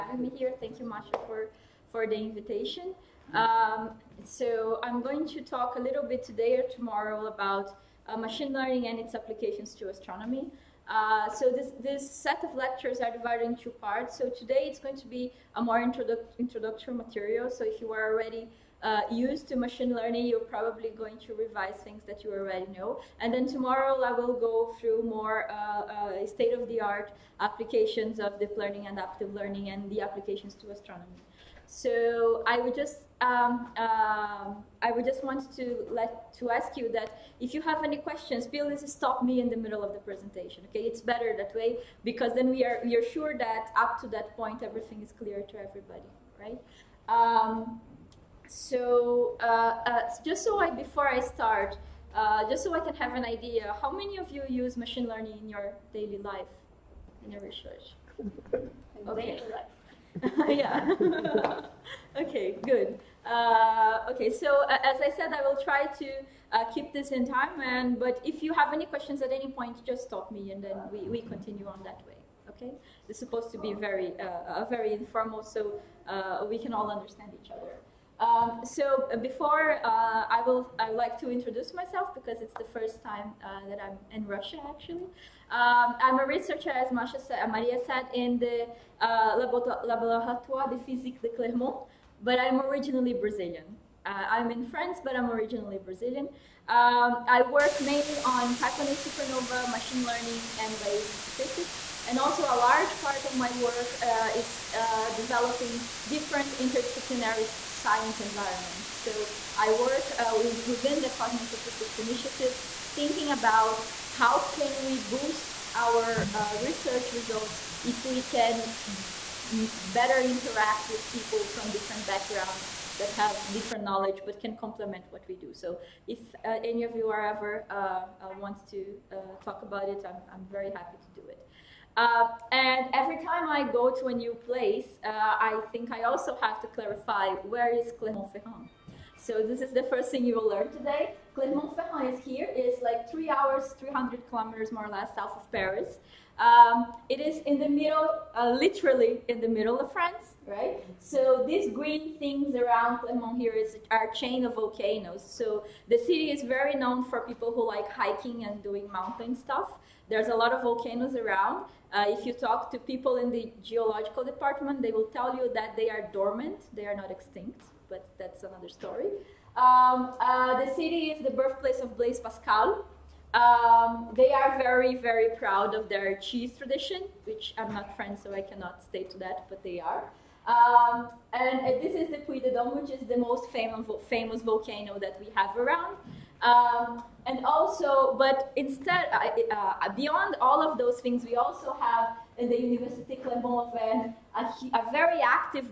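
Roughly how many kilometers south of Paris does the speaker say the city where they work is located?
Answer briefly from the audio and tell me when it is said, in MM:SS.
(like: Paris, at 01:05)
300, at 02:23.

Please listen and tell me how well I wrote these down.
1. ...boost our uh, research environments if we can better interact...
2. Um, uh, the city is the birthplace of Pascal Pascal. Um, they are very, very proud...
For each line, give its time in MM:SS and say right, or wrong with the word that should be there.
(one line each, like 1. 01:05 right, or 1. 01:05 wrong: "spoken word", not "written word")
1. 01:54 wrong: "results", not "environments"
2. 02:49 wrong: "Blaise", not "Pascal".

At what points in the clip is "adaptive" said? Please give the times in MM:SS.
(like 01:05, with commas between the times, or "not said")
00:28.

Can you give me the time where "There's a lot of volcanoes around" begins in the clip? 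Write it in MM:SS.
02:40.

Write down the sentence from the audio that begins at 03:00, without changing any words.
Um, and, this is the Puy de Dôme, which is the most famous, famous volcano that we have around.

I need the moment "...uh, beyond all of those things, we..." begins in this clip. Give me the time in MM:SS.
03:09.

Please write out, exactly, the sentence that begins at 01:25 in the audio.
Um, I'm a researcher, as uh, Maria said, in the uh, Laboratoire de Physique de Clermont, but I'm originally Brazilian.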